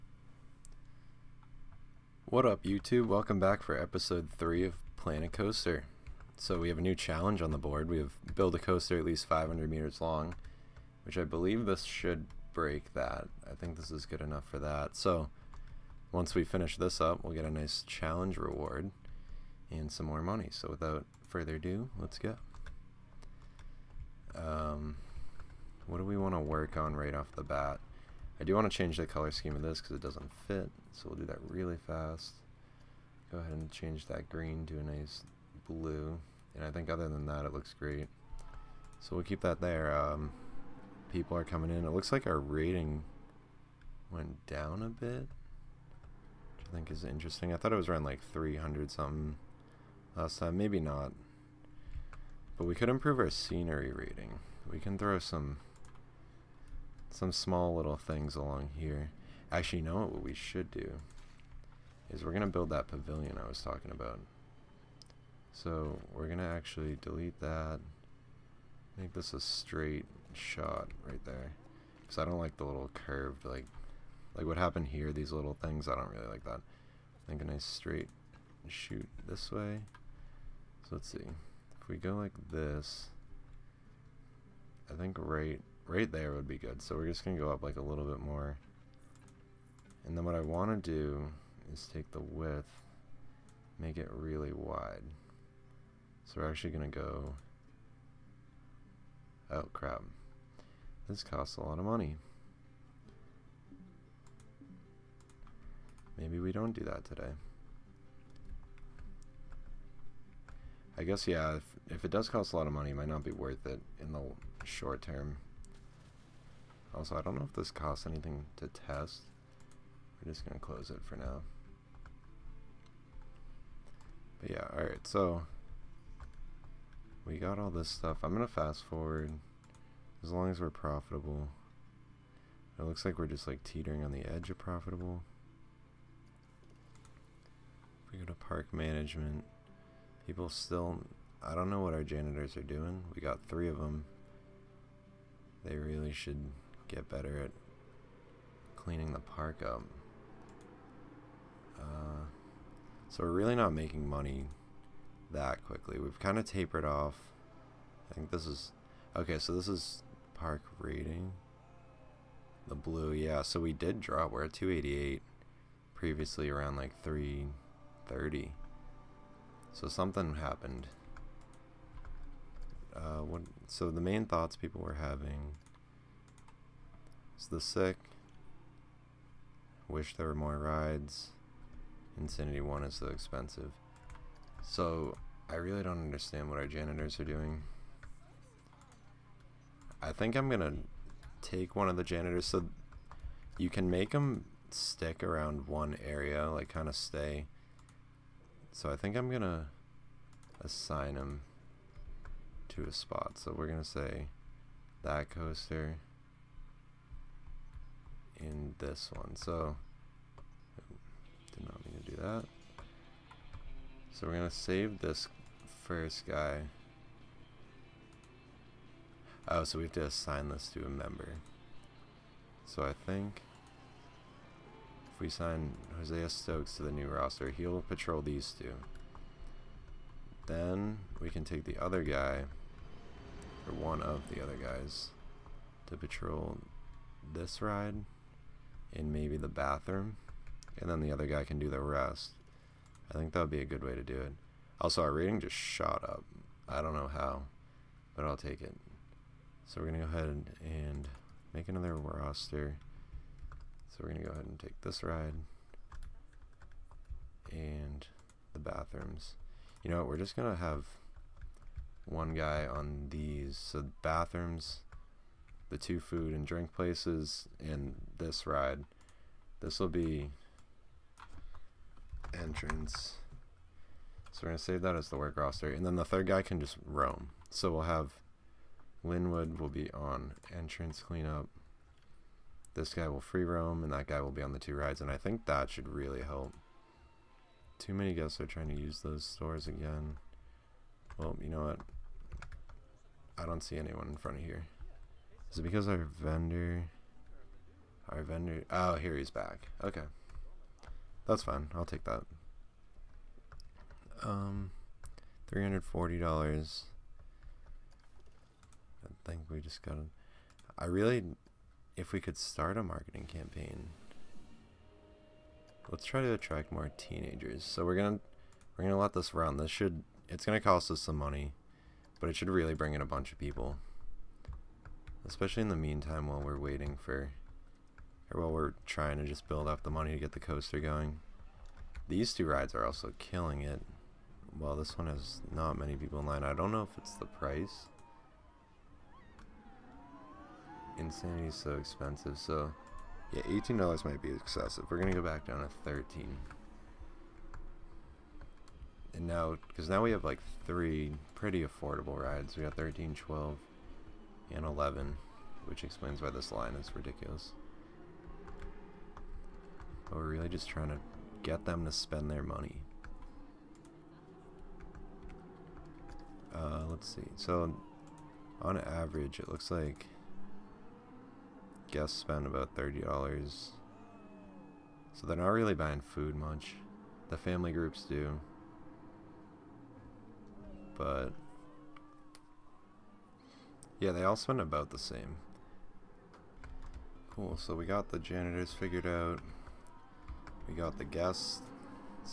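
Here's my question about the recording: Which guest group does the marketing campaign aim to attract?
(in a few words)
Teenagers.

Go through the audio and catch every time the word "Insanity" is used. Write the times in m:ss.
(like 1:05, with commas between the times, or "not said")
3:02, 5:40.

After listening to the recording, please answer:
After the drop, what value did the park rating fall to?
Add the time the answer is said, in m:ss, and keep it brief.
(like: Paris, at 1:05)
288, at 2:44.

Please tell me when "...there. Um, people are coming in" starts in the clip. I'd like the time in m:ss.
0:39.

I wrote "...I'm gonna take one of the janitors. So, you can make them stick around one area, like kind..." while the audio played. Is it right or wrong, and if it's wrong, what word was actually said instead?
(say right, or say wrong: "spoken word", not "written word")
right.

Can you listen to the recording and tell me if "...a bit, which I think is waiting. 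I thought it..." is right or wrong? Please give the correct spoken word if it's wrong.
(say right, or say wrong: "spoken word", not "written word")
wrong: "interesting", not "waiting".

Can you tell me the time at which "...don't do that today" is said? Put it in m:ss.
1:46.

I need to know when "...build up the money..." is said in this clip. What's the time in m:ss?
5:29.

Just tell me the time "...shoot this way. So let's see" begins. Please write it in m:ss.
1:18.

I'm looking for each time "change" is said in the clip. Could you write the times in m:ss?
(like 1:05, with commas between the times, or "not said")
0:28, 0:33.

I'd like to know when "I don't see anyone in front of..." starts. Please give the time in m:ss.
4:53.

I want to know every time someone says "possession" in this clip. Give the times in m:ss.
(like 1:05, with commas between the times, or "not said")
not said.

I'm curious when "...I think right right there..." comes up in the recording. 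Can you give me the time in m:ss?
1:24.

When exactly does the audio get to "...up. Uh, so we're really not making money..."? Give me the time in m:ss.
2:29.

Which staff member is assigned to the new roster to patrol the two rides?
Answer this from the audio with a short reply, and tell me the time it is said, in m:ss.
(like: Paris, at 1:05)
Hosea Stokes, at 3:45.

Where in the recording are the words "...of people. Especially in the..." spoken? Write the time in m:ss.
5:23.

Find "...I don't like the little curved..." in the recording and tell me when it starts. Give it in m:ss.
1:12.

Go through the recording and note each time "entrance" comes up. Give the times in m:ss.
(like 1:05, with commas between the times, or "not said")
4:32, 4:40.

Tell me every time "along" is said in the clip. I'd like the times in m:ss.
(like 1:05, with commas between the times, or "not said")
0:58.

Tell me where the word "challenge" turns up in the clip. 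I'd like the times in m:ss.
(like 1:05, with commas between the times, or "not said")
0:06, 0:17.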